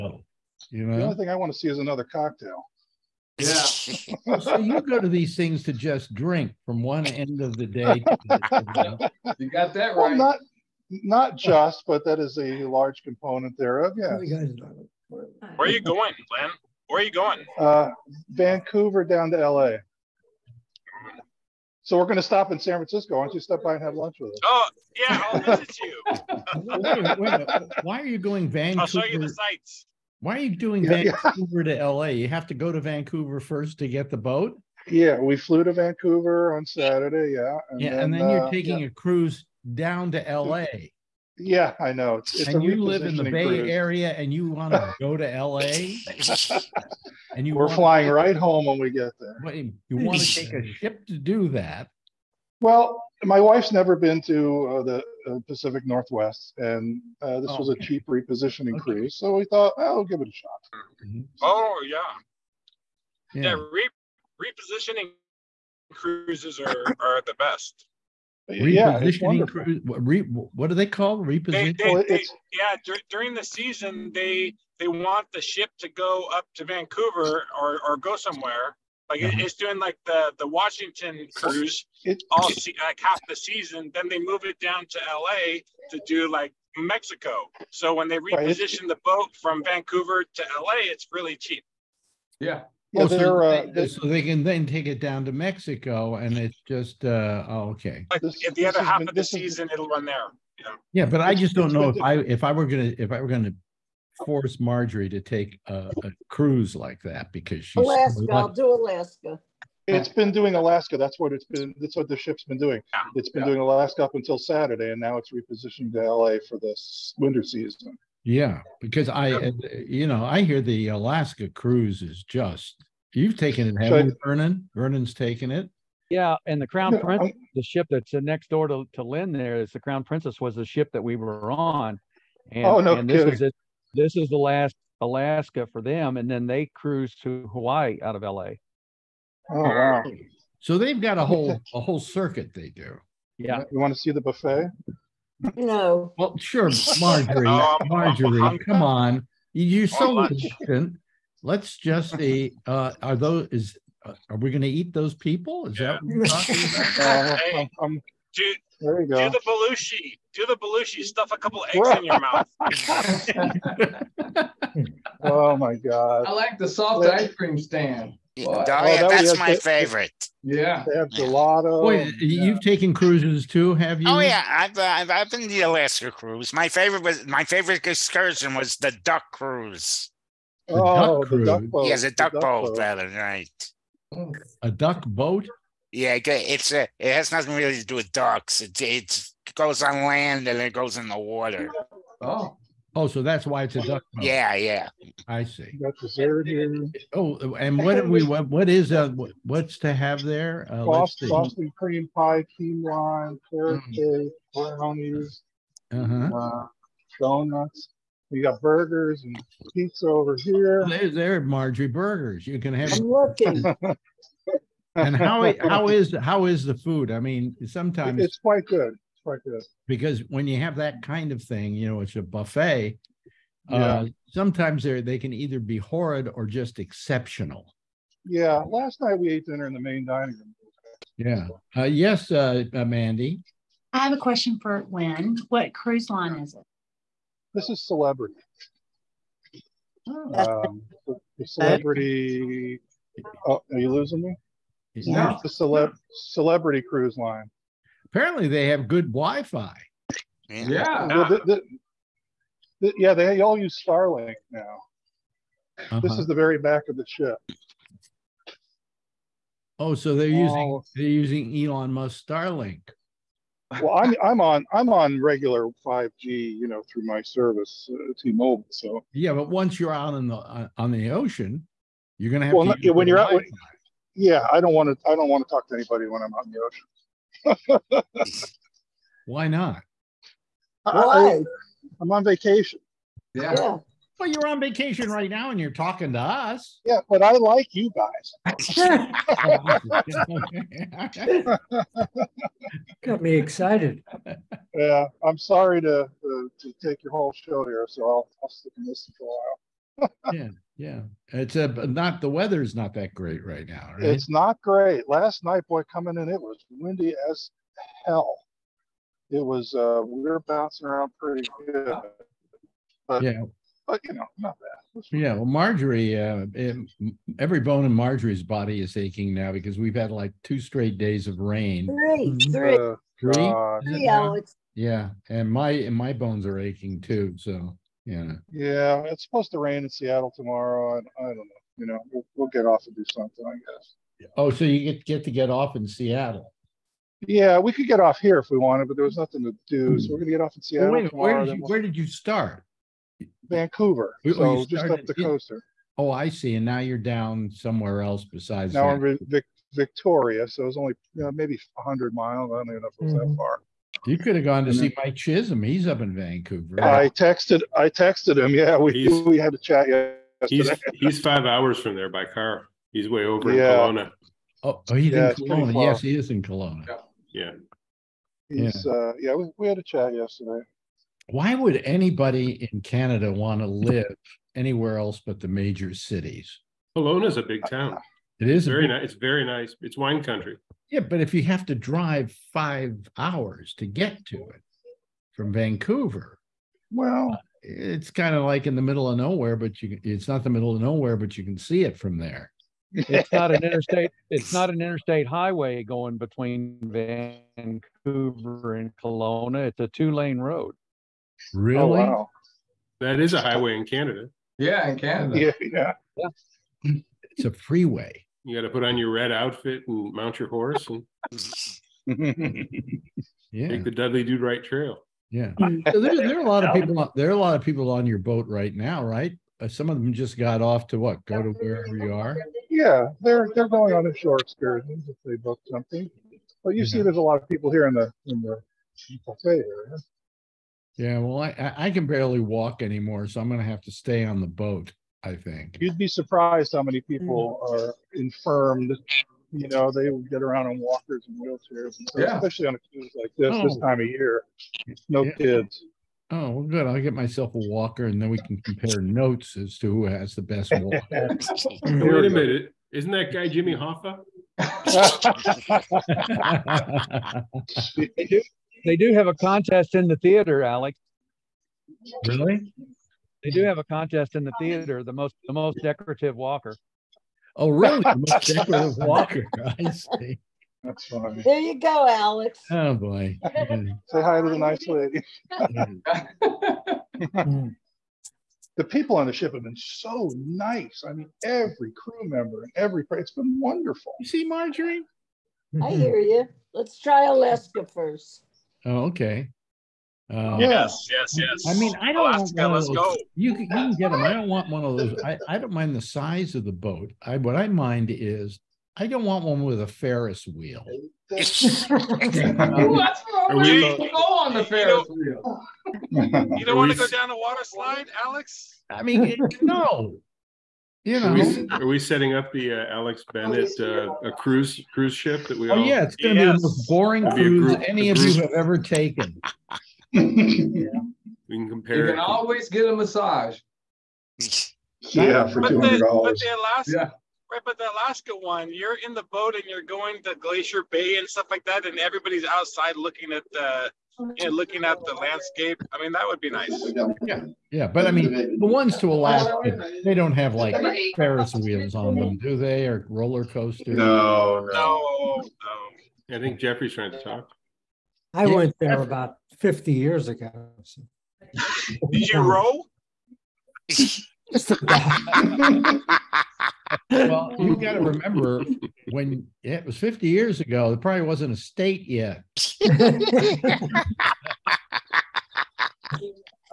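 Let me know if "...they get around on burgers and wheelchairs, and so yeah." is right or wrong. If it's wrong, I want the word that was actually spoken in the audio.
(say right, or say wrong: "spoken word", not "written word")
wrong: "walkers", not "burgers".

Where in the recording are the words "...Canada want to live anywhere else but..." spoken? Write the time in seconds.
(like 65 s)
372 s.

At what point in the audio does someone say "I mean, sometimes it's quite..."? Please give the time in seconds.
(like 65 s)
217 s.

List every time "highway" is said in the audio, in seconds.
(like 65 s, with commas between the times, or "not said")
395 s, 403 s.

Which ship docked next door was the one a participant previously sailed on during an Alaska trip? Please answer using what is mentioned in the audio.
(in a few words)
Crown Princess.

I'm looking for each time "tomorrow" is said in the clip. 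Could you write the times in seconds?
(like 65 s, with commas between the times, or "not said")
330 s, 341 s.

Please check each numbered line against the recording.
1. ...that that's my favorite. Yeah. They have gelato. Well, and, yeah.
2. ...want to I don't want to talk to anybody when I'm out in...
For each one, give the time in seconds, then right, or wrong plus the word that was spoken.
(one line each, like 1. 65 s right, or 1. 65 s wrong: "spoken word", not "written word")
1. 169 s right
2. 274 s right.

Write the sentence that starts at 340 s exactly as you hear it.
we're gonna get off in Seattle.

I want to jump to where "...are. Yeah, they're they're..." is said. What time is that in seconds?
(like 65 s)
422 s.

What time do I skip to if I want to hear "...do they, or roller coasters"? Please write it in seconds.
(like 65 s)
542 s.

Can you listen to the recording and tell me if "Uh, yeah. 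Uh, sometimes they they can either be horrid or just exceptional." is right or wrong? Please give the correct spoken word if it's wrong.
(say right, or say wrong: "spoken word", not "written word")
right.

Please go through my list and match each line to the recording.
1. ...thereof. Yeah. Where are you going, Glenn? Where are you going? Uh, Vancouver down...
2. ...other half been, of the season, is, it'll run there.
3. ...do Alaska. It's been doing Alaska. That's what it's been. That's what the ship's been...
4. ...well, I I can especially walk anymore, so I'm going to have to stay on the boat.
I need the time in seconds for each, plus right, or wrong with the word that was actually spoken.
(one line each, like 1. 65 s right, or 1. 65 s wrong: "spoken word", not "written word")
1. 13 s right
2. 98 s right
3. 108 s right
4. 431 s wrong: "barely", not "especially".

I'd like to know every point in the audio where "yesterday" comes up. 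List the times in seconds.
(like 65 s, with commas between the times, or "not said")
359 s, 370 s.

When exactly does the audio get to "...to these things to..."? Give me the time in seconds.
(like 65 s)
4 s.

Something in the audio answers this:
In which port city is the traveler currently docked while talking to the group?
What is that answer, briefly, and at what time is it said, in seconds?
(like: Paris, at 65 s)
Victoria, at 348 s.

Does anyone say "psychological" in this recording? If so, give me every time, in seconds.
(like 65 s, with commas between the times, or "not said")
not said.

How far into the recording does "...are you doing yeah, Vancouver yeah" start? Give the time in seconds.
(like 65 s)
30 s.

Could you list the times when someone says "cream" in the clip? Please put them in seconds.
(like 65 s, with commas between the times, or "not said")
167 s, 201 s.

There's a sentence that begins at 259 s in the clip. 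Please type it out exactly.
Oh, so they're using they're using Elon Musk Starlink.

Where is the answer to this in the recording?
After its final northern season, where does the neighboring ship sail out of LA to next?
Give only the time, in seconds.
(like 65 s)
136 s.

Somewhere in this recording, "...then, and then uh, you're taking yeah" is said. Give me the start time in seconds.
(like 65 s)
37 s.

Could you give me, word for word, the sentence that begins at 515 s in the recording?
Oh all, yeah, it's going to yes.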